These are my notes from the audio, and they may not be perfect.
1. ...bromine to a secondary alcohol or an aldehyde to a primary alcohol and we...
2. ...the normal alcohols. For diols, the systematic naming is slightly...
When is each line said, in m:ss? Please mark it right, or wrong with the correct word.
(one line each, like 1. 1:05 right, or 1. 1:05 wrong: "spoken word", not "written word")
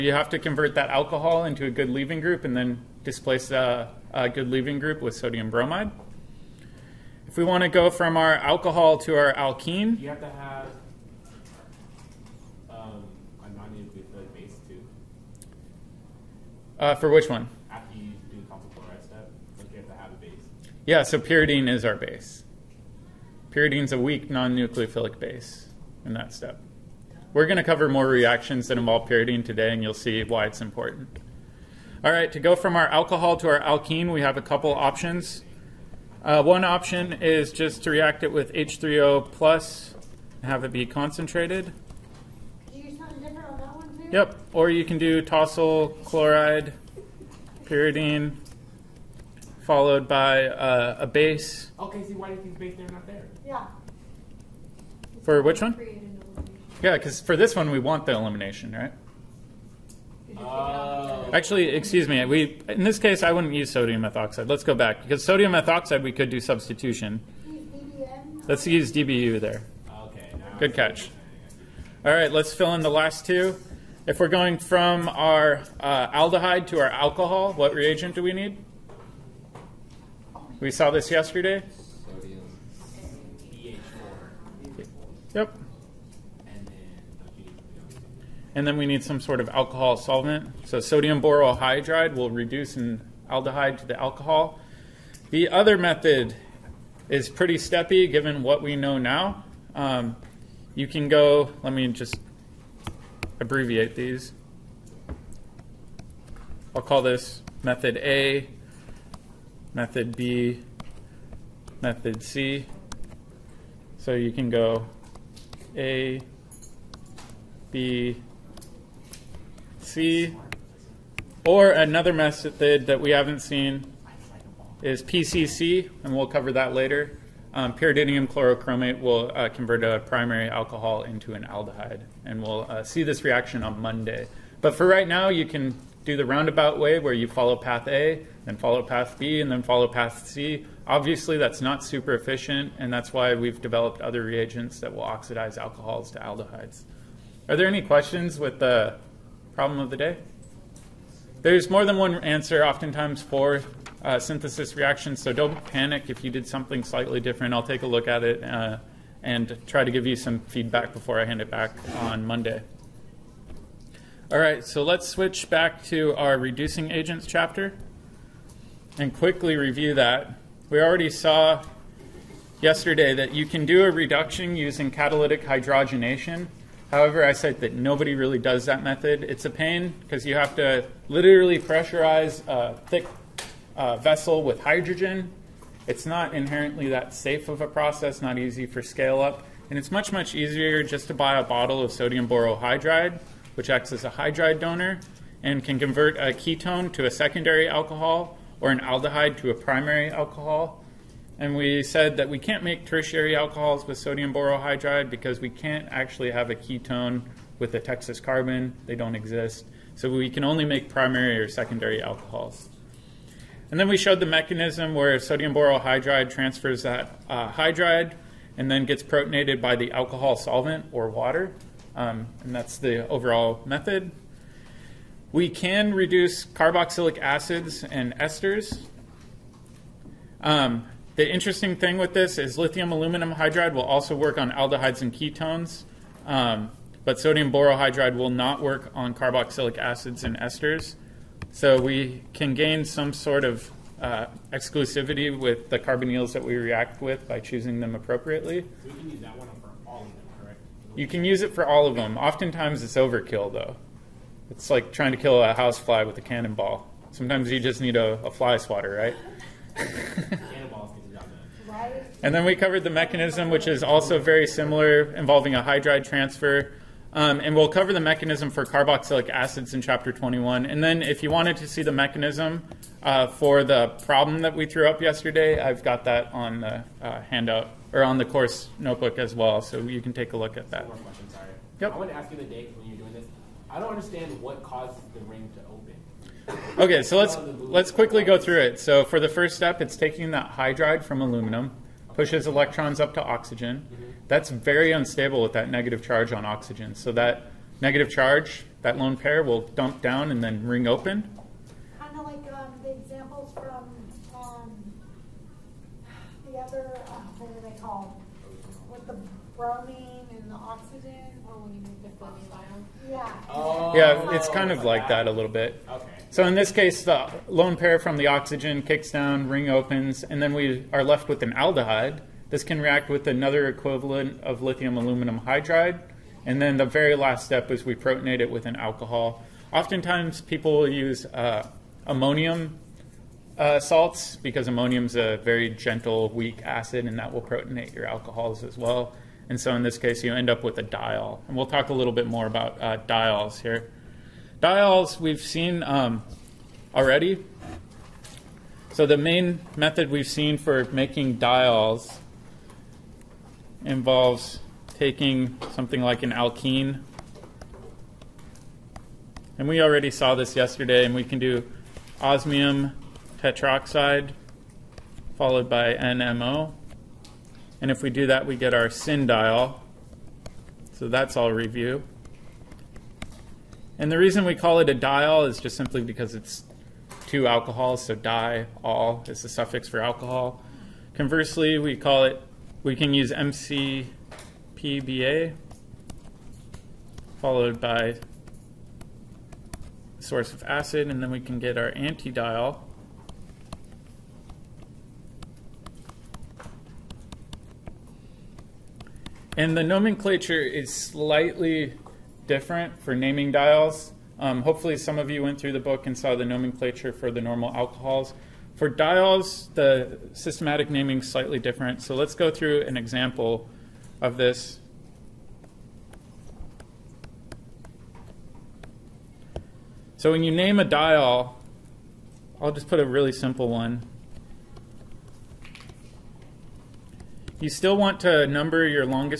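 1. 3:16 wrong: "ketone", not "bromine"
2. 6:47 right.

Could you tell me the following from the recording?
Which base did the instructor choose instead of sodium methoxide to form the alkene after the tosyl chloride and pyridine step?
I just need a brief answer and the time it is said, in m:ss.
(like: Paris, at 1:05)
DBU, at 1:08.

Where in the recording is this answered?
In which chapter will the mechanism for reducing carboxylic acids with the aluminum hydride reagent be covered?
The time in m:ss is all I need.
4:29.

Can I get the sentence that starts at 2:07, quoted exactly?
Um, pyridinium chlorochromate will uh, convert a primary alcohol into an aldehyde, and we'll uh, see this reaction on Monday.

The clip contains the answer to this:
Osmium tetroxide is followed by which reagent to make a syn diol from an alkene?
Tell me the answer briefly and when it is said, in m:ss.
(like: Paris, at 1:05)
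NMO, at 6:05.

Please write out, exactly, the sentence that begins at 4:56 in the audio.
So that negative charge, that lone pair, will dump down and then ring open.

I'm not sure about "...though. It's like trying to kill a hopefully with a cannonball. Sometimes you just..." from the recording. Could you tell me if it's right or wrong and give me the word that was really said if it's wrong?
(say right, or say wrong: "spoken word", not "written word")
wrong: "housefly", not "hopefully".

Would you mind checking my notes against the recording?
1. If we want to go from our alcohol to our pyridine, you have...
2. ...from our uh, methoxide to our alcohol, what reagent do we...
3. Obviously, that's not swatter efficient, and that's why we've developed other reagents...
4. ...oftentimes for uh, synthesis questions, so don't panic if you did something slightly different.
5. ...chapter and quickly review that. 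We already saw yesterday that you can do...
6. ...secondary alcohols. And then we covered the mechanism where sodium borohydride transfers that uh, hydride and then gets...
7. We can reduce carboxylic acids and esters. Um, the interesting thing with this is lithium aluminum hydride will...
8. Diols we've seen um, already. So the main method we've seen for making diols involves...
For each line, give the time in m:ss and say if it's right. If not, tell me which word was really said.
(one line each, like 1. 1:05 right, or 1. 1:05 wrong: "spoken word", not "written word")
1. 0:07 wrong: "alkene", not "pyridine"
2. 1:14 wrong: "aldehyde", not "methoxide"
3. 2:20 wrong: "super", not "swatter"
4. 2:32 wrong: "reactions", not "questions"
5. 2:47 right
6. 3:31 wrong: "showed", not "covered"
7. 3:45 right
8. 5:44 right.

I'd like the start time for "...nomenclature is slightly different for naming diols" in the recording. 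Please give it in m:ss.
6:39.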